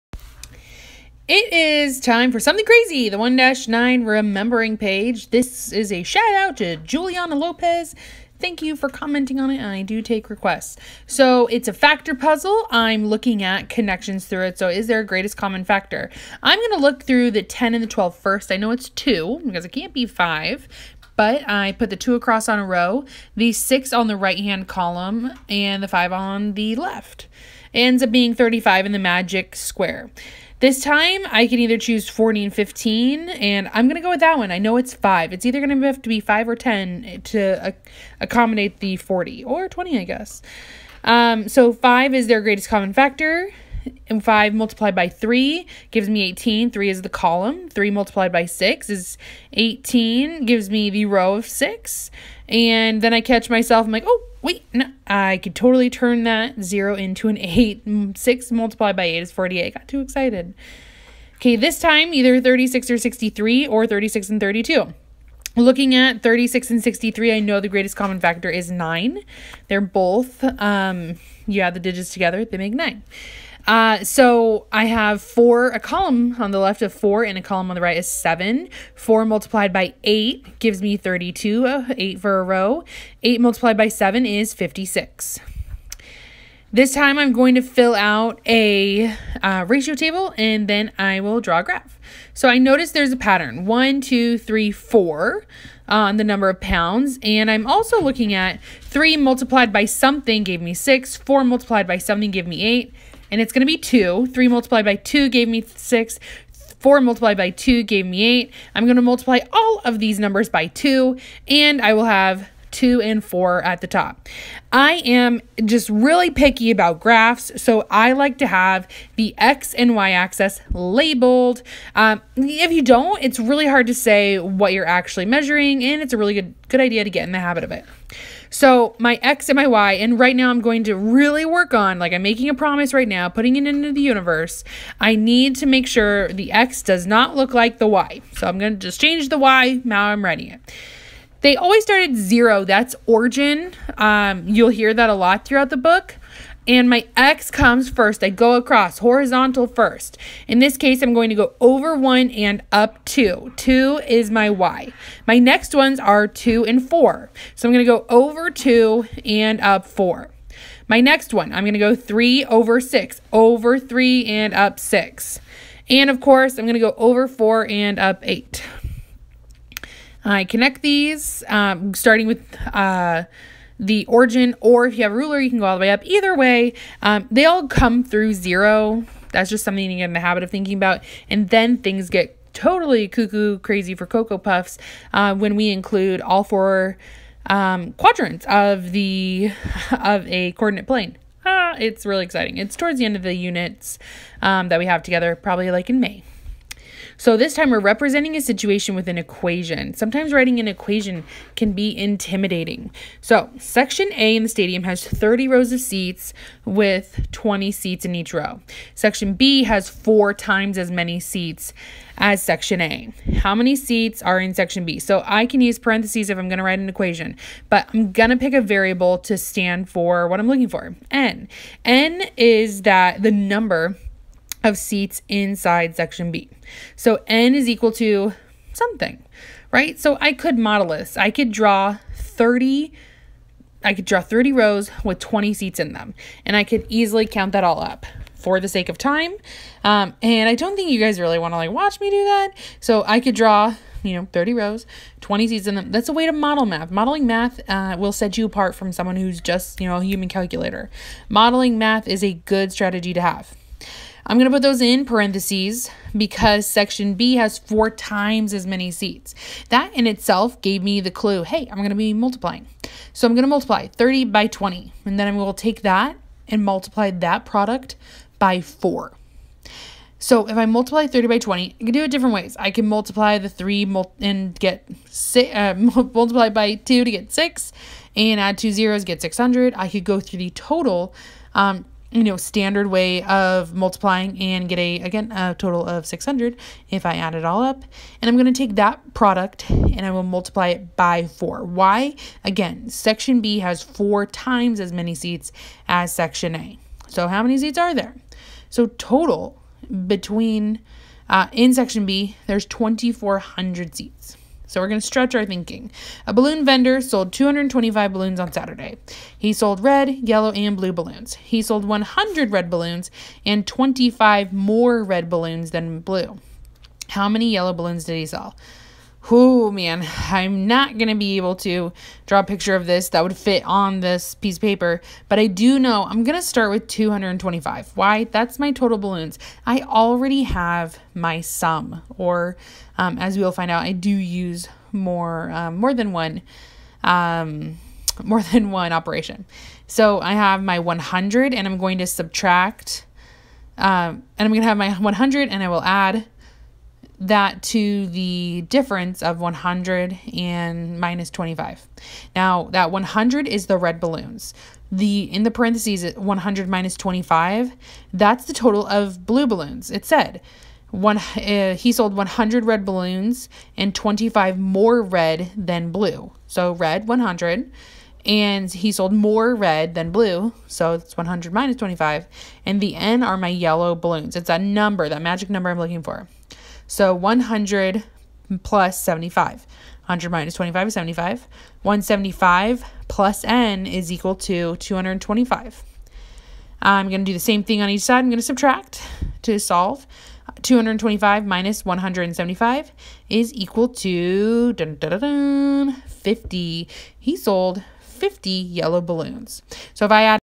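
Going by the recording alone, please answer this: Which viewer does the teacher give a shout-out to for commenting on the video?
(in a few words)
Juliana Lopez.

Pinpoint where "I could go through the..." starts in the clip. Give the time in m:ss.
4:39.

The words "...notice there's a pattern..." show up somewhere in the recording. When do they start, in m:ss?
1:32.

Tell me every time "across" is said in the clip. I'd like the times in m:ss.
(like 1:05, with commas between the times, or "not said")
0:22, 2:28.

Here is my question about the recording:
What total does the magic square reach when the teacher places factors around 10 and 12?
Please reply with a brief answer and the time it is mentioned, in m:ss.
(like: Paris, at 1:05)
35, at 0:28.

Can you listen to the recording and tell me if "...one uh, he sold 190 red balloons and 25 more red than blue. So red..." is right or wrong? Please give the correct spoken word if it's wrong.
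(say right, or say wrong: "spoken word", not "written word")
wrong: "100", not "190".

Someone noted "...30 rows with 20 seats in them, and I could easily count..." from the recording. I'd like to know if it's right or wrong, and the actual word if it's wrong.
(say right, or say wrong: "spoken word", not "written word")
right.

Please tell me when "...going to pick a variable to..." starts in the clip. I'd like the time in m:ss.
3:38.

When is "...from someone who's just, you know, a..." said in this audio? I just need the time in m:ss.
4:08.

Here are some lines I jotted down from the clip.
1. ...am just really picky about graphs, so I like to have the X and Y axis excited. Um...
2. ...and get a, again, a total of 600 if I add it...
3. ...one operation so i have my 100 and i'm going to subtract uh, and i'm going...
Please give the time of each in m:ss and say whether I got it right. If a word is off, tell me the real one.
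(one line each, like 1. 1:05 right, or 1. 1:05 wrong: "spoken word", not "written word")
1. 1:55 wrong: "labeled", not "excited"
2. 4:44 right
3. 5:38 right.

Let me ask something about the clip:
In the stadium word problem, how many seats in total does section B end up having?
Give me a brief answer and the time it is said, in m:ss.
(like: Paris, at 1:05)
2,400, at 5:02.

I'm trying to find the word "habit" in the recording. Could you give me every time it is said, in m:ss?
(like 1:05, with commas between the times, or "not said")
2:07, 3:00.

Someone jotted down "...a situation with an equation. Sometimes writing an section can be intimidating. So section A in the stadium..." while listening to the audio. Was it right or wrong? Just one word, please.
wrong.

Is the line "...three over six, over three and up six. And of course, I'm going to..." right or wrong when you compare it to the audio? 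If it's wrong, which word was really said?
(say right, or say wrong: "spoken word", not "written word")
right.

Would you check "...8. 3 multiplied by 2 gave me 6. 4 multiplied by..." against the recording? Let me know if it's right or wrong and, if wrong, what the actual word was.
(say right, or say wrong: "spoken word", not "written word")
wrong: "2", not "8".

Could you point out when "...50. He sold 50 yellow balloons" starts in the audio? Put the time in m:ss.
6:35.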